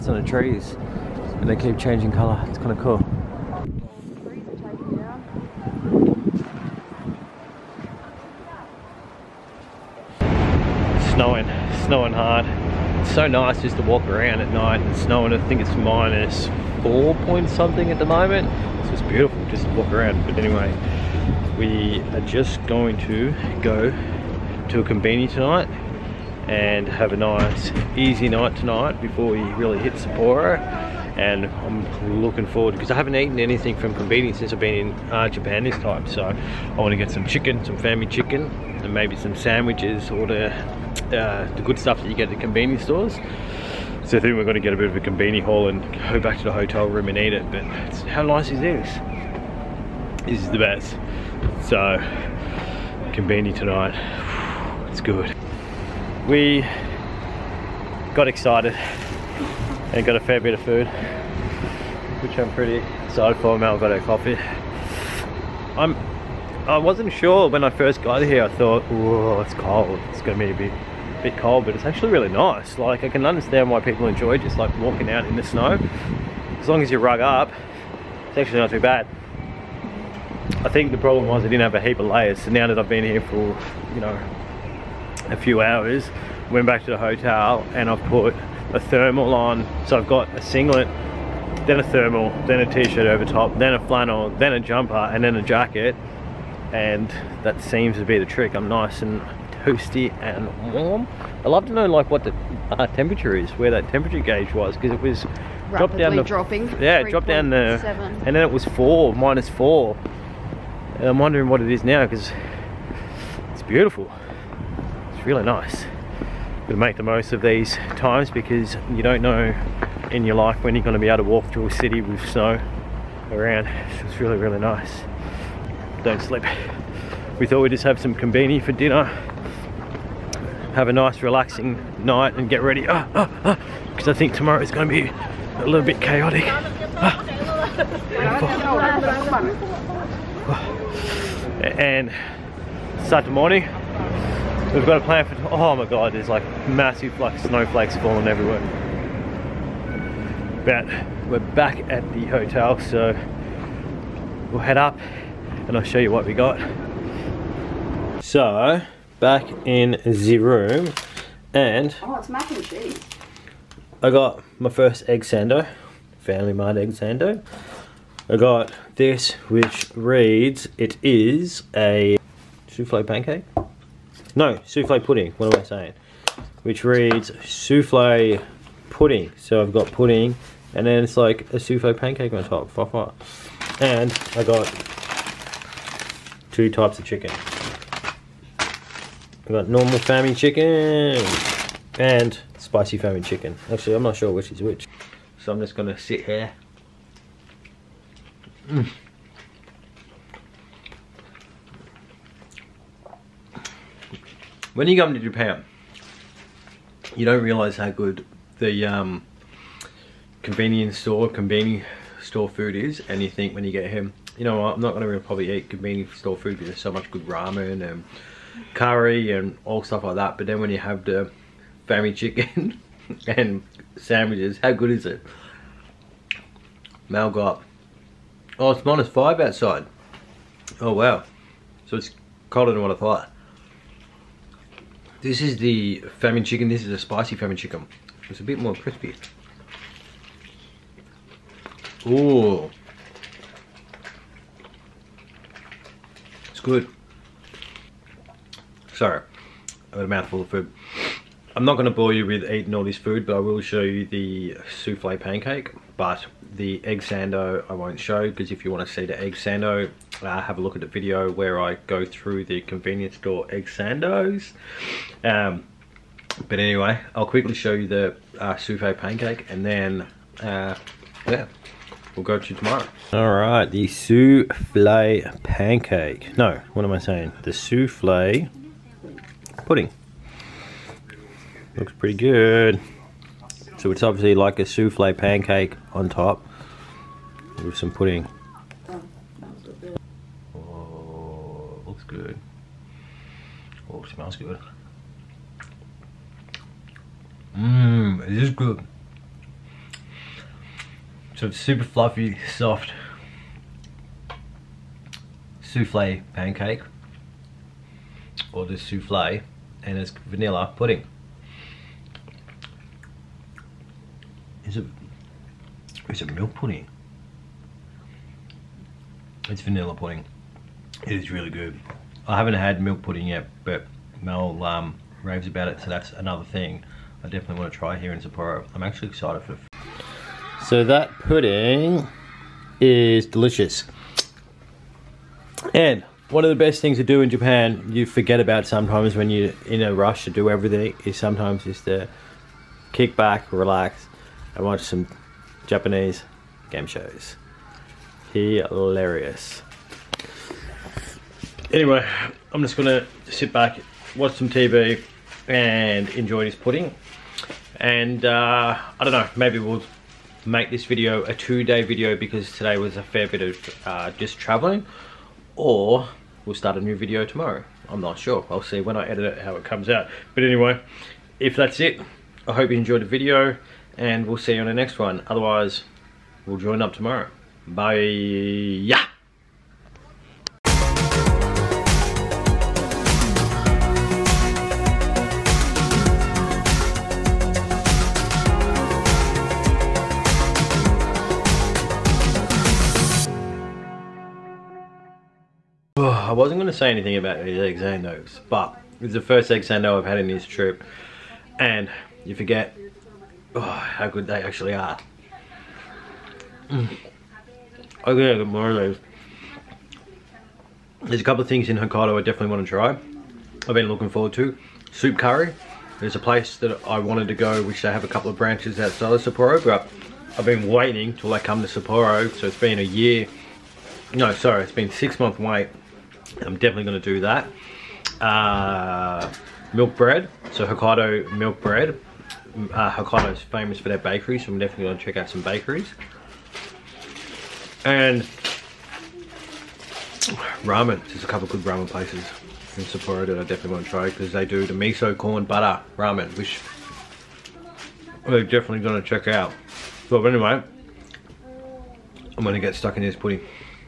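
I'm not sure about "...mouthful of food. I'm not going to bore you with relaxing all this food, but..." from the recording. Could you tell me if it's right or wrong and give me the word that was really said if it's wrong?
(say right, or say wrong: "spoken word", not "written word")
wrong: "eating", not "relaxing".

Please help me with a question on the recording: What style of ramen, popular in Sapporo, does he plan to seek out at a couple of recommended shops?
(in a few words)
Miso corn butter ramen.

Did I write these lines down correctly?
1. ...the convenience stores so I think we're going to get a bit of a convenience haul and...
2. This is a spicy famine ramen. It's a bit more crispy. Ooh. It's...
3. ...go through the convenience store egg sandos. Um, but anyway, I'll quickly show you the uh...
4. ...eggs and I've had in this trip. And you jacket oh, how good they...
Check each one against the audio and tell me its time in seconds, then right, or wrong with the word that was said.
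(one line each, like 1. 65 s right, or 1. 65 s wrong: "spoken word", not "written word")
1. 42 s right
2. 236 s wrong: "chicken", not "ramen"
3. 261 s right
4. 399 s wrong: "forget", not "jacket".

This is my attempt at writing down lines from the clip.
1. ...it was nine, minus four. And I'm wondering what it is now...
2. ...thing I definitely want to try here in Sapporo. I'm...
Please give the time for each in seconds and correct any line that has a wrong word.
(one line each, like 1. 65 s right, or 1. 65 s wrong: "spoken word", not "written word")
1. 108 s wrong: "four", not "nine"
2. 326 s right.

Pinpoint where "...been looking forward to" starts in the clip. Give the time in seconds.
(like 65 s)
413 s.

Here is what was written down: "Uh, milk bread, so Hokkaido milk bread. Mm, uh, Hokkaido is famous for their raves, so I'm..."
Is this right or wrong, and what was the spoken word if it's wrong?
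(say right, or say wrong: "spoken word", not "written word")
wrong: "bakeries", not "raves".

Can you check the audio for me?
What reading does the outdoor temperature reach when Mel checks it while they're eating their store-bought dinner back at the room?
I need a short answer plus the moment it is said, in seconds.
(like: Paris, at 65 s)
Minus 5, at 228 s.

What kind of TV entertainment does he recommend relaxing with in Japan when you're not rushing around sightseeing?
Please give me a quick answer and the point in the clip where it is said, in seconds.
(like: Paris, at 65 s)
Japanese game shows, at 345 s.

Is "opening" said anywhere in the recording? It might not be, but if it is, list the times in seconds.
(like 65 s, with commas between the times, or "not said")
not said.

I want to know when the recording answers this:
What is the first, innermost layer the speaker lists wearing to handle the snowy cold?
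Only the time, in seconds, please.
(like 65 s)
90 s.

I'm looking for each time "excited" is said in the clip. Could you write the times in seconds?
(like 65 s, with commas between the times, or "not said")
58 s, 63 s, 329 s.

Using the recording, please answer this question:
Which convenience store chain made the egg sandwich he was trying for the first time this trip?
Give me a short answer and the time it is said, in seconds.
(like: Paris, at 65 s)
Family Mart, at 166 s.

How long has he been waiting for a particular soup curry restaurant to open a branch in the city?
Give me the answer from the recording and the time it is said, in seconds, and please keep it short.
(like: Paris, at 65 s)
6 months, at 424 s.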